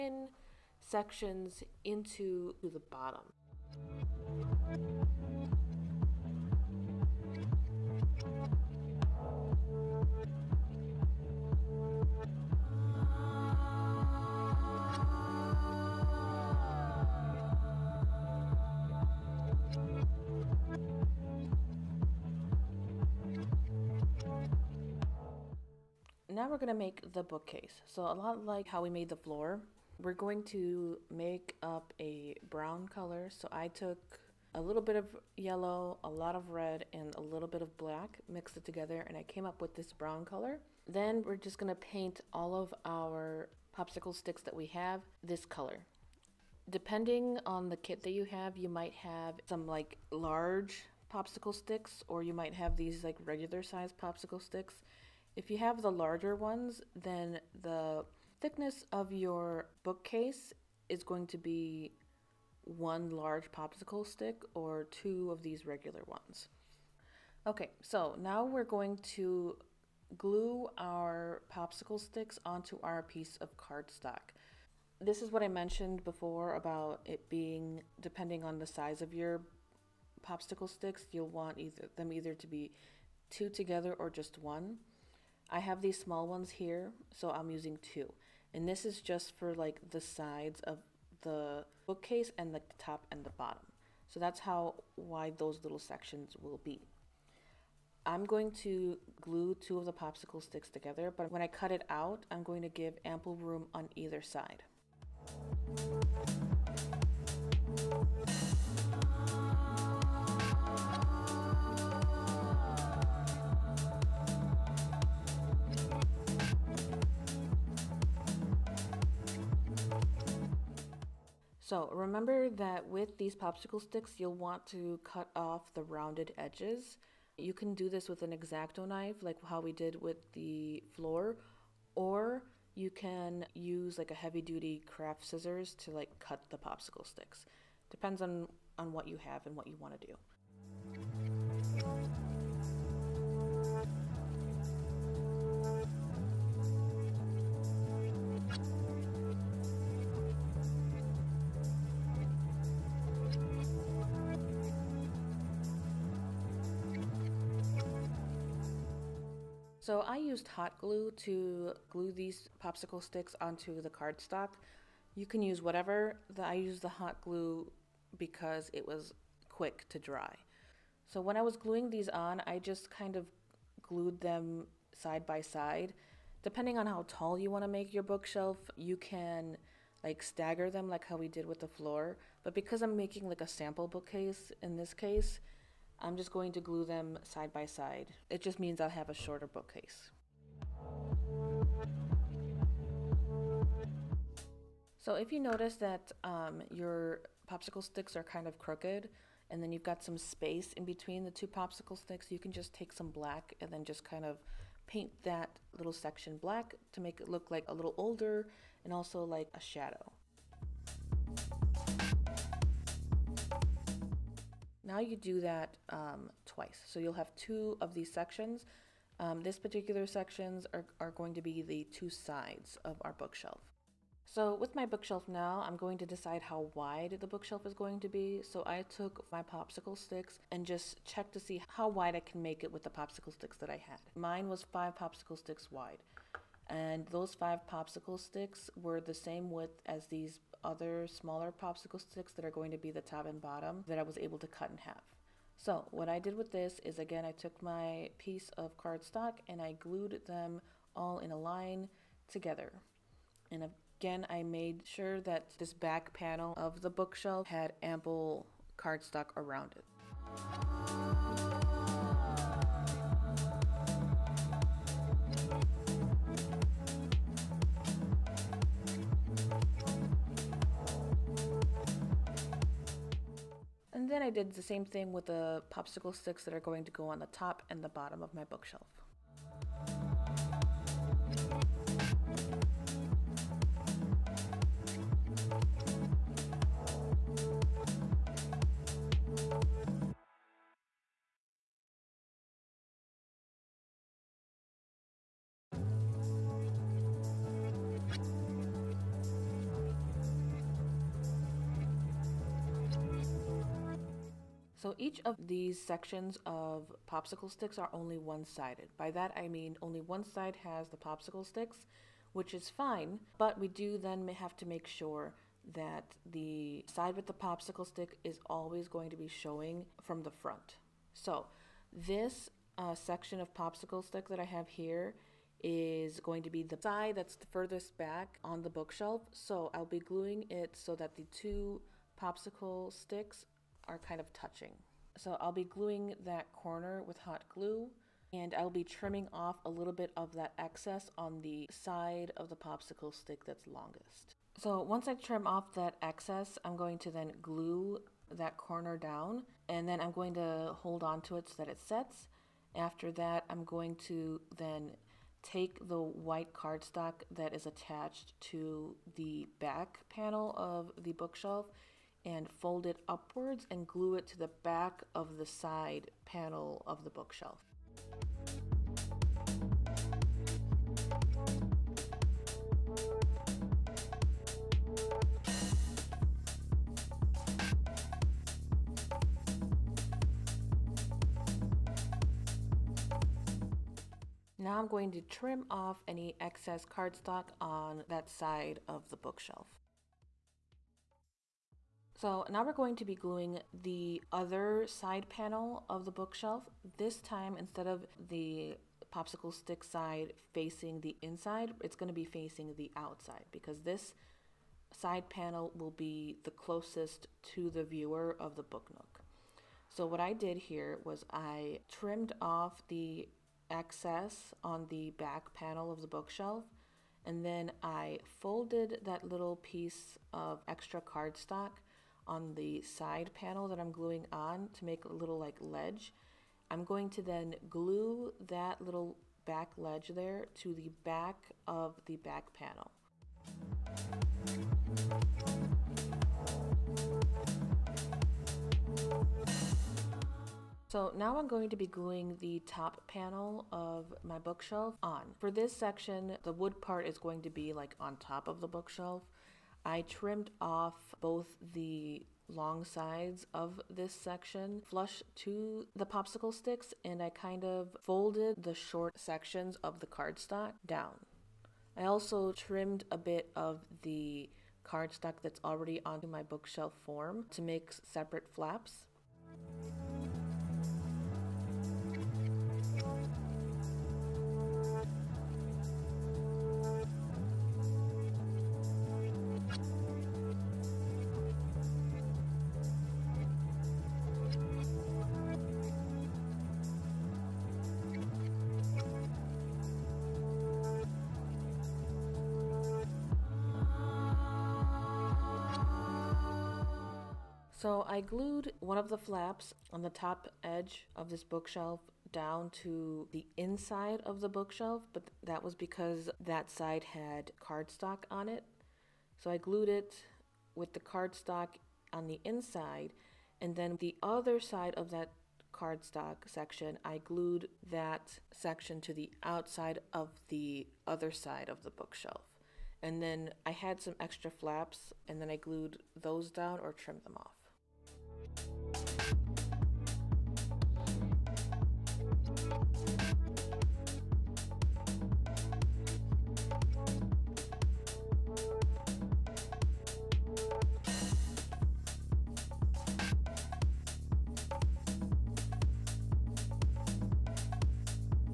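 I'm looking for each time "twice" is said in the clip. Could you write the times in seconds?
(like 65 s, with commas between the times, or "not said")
216 s.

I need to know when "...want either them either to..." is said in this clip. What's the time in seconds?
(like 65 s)
81 s.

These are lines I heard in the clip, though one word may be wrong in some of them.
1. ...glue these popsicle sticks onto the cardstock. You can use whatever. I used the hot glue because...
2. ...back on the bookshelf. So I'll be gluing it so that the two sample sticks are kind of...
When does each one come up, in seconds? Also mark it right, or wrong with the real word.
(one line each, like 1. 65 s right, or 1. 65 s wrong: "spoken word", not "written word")
1. 161 s right
2. 327 s wrong: "popsicle", not "sample".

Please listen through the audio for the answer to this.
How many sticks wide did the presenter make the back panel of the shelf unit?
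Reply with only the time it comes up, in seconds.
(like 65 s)
234 s.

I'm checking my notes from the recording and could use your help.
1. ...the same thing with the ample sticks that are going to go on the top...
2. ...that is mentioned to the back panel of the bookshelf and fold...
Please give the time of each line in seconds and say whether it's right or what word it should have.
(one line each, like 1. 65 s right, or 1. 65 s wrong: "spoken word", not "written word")
1. 274 s wrong: "popsicle", not "ample"
2. 357 s wrong: "attached", not "mentioned".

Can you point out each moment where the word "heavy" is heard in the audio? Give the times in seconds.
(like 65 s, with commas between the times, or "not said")
134 s.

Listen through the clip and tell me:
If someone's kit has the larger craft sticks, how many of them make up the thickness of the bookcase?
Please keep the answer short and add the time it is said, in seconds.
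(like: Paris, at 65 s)
1, at 62 s.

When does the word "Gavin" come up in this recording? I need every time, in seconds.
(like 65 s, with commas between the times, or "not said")
not said.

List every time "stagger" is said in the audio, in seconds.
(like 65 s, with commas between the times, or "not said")
180 s.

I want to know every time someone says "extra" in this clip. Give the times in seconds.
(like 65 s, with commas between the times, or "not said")
420 s, 524 s.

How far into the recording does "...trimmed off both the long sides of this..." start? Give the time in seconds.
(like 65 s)
450 s.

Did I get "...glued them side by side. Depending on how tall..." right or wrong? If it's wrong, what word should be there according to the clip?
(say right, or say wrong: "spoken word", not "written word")
right.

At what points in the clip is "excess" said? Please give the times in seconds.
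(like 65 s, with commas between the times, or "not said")
340 s, 346 s, 386 s, 413 s.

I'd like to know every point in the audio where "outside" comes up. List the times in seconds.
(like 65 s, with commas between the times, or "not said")
402 s, 519 s.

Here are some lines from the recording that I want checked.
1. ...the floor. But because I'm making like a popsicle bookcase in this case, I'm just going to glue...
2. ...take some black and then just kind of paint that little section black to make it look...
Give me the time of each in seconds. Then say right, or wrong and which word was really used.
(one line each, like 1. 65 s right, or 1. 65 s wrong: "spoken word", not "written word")
1. 181 s wrong: "sample", not "popsicle"
2. 202 s right.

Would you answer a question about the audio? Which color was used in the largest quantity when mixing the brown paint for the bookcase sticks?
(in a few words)
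red.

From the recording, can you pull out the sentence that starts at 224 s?
So with my bookshelf now, I'm going to decide how wide the bookshelf is going to be.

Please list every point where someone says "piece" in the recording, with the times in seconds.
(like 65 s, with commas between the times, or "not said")
73 s, 248 s, 419 s.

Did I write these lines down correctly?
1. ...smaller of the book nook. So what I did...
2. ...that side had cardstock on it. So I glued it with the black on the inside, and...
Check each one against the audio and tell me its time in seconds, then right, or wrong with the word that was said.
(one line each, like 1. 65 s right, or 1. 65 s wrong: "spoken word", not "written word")
1. 407 s wrong: "viewer", not "smaller"
2. 506 s wrong: "cardstock", not "black".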